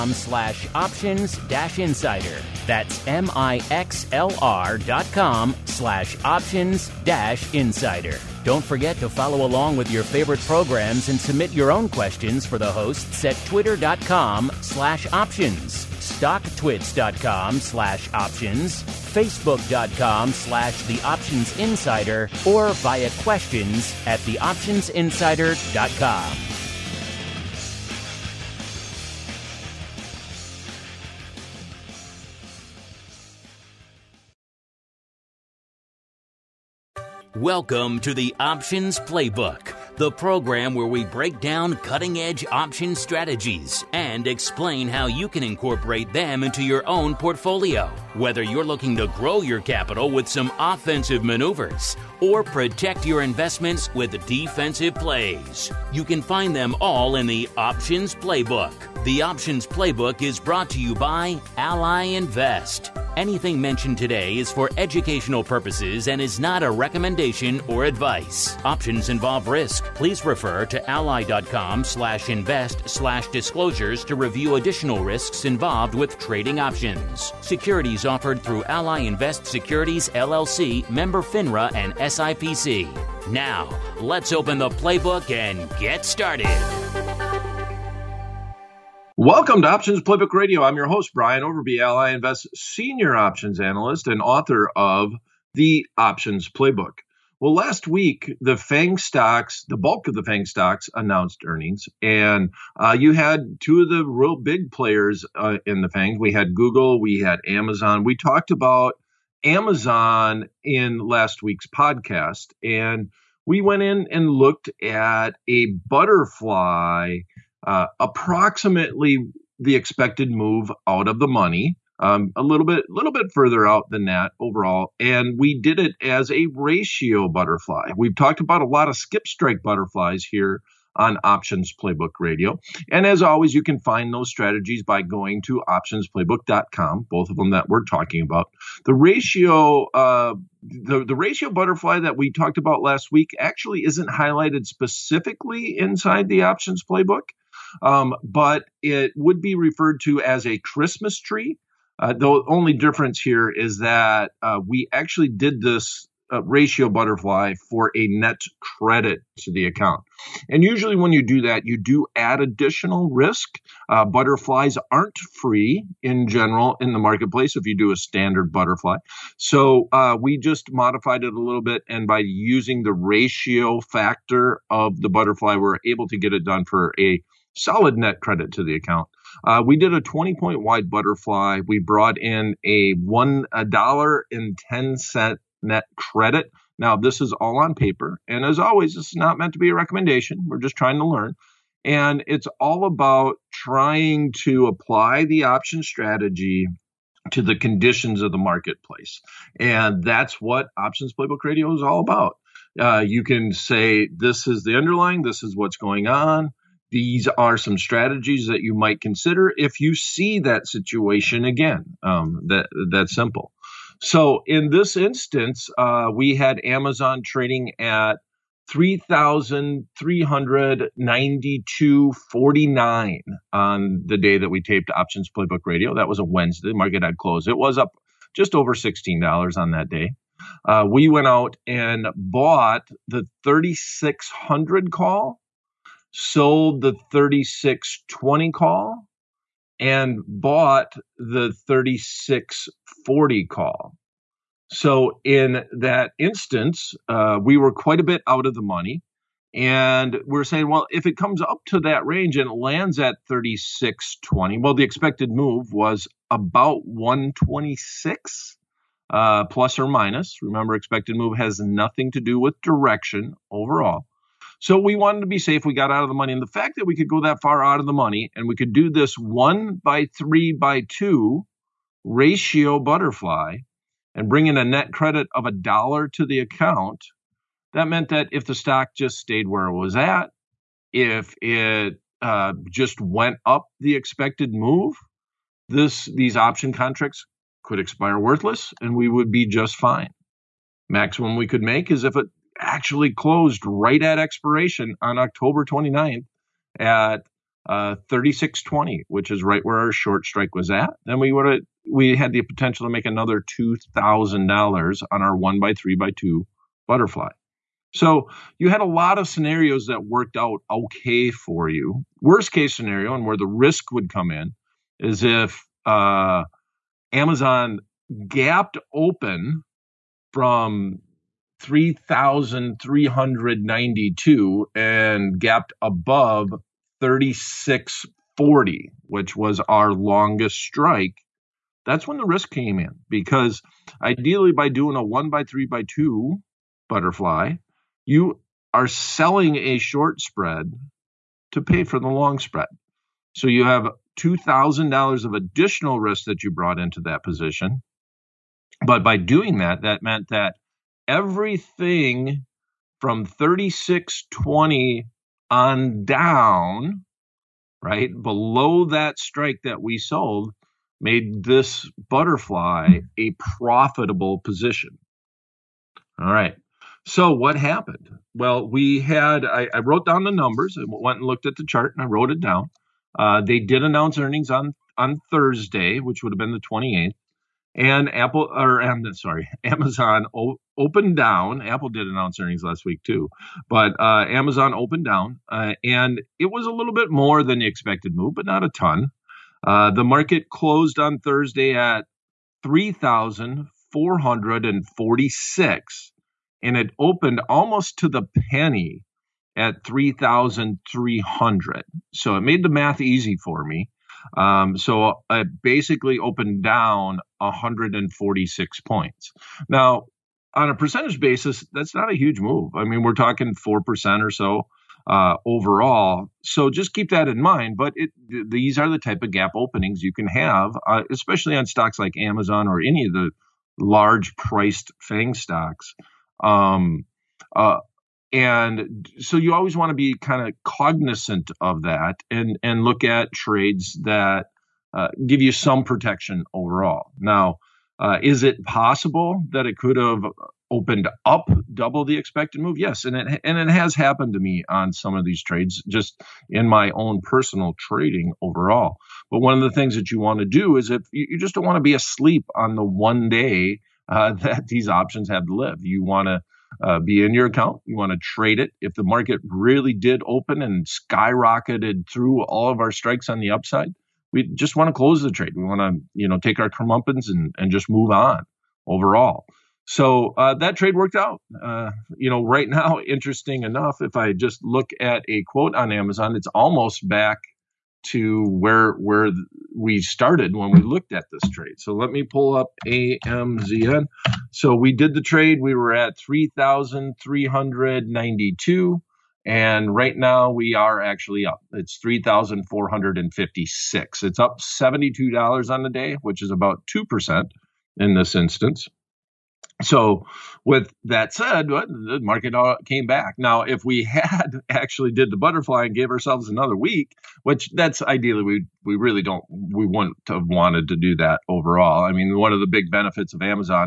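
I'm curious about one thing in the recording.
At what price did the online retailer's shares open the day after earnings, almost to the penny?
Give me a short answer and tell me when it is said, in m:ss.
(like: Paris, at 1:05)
3,300, at 6:39.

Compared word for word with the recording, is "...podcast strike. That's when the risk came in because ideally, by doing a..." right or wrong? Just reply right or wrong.
wrong.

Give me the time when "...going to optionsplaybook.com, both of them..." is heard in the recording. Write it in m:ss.
2:15.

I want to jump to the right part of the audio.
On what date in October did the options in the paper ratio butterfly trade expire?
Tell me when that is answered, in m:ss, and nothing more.
4:55.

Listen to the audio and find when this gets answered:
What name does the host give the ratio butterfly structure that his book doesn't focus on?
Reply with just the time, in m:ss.
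2:30.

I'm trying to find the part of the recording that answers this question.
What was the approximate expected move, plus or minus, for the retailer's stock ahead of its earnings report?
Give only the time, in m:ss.
4:16.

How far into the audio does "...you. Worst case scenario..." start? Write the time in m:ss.
5:11.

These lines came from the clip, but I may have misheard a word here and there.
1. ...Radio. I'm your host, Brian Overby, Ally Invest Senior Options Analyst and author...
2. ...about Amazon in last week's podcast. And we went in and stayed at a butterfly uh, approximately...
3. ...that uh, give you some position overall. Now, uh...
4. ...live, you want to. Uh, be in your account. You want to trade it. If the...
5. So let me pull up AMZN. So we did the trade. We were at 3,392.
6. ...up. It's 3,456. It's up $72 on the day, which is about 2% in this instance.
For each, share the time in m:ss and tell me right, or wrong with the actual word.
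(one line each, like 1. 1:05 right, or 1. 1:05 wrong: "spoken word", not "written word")
1. 1:30 right
2. 1:48 wrong: "looked", not "stayed"
3. 7:14 wrong: "protection", not "position"
4. 7:35 right
5. 8:01 right
6. 8:11 right.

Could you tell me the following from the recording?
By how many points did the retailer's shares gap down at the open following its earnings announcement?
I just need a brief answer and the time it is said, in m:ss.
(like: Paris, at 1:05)
146, at 6:47.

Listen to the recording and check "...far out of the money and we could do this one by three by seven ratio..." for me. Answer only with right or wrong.
wrong.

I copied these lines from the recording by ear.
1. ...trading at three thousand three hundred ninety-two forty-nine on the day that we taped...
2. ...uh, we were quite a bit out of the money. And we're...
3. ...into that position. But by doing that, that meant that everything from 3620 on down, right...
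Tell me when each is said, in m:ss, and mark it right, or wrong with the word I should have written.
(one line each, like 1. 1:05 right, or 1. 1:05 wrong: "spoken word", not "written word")
1. 3:37 right
2. 4:07 right
3. 5:46 right.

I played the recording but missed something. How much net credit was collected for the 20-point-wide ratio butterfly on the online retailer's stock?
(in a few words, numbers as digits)
$1.10.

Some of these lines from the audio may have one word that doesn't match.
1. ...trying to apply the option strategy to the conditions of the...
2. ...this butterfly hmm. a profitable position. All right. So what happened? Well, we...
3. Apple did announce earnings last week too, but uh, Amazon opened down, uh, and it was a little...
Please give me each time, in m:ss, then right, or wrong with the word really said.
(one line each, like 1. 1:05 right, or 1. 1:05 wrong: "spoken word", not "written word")
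1. 3:13 right
2. 6:01 right
3. 6:21 right.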